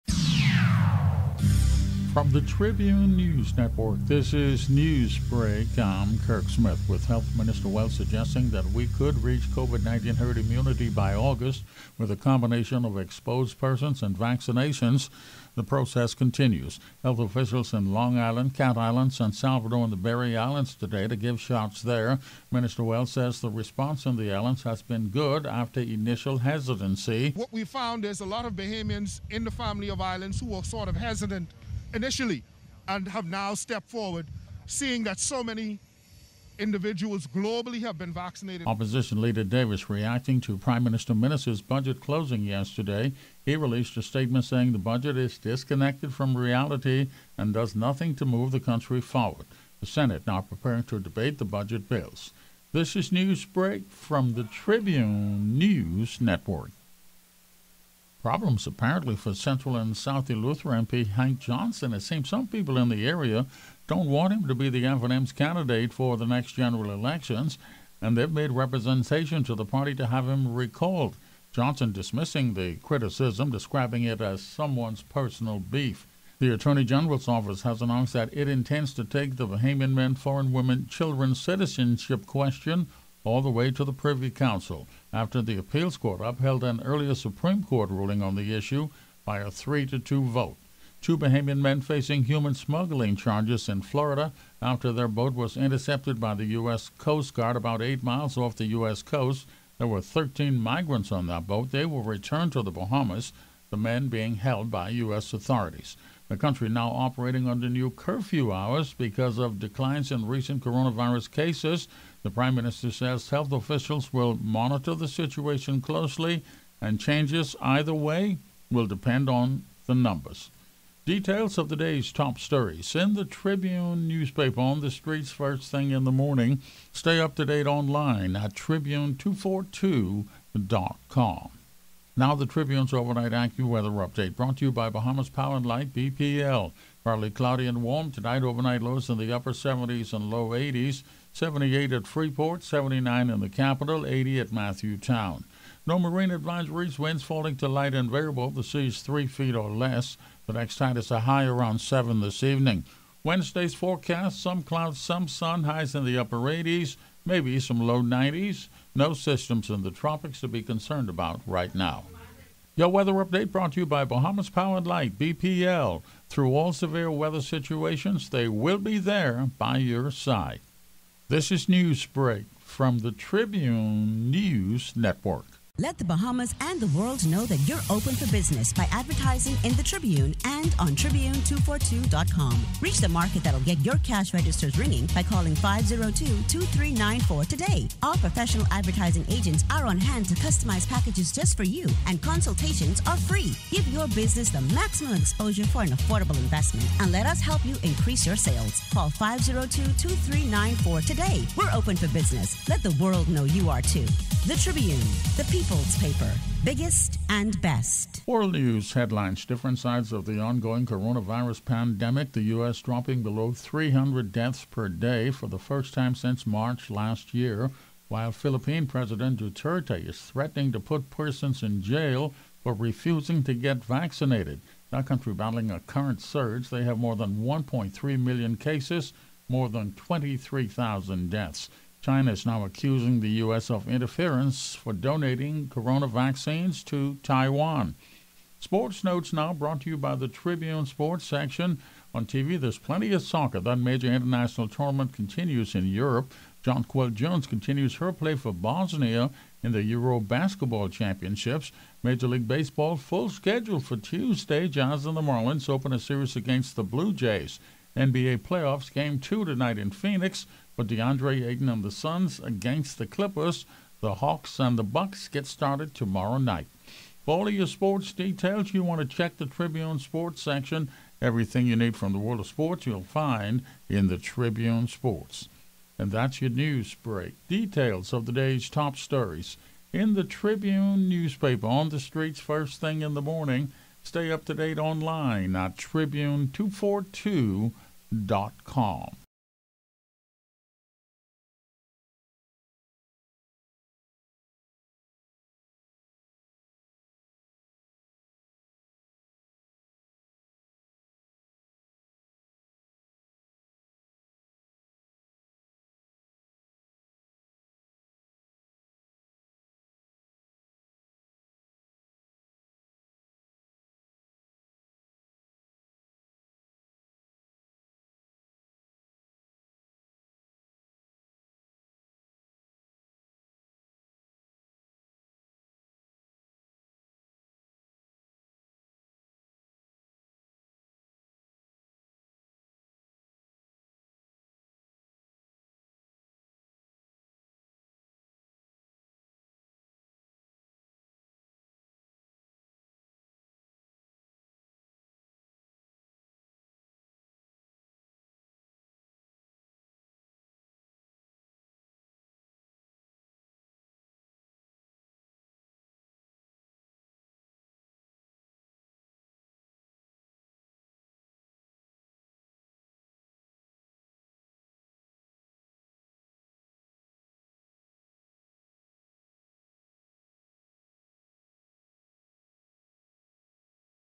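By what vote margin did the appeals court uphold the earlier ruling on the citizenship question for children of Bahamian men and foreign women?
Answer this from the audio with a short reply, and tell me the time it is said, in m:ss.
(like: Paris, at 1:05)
3 to 2, at 1:29.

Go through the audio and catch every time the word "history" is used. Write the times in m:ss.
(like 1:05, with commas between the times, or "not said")
not said.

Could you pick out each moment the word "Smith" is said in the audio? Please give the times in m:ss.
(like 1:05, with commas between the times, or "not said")
0:06.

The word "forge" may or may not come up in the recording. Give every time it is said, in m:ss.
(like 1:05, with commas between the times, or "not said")
not said.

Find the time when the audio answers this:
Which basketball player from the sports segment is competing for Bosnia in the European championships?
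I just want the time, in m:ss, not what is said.
4:06.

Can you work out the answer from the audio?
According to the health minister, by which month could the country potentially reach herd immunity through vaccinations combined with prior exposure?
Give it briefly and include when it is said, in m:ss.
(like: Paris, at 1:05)
August, at 0:11.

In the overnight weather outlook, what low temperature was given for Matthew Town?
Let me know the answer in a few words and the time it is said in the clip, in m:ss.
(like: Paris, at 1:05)
80, at 2:24.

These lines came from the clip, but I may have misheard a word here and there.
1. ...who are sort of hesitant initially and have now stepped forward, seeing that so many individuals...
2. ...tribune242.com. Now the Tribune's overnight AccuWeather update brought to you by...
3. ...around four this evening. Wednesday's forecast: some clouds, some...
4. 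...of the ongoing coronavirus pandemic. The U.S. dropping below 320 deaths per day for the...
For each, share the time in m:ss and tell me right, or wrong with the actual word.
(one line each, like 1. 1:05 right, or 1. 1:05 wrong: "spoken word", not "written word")
1. 0:30 right
2. 2:08 right
3. 2:31 wrong: "seven", not "four"
4. 3:30 wrong: "300", not "320".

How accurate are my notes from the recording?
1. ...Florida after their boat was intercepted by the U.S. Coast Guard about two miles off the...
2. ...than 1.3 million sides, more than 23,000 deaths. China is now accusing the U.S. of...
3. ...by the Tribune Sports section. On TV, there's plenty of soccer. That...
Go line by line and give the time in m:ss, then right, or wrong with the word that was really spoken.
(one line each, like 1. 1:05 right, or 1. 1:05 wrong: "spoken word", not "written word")
1. 1:33 wrong: "eight", not "two"
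2. 3:47 wrong: "cases", not "sides"
3. 3:59 right.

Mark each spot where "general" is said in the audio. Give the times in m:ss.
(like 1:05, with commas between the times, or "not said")
1:06, 1:16.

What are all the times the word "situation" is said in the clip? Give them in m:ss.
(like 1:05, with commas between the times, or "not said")
1:55, 2:47.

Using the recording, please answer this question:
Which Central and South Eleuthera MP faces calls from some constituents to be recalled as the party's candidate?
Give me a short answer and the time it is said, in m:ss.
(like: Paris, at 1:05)
Hank Johnson, at 1:01.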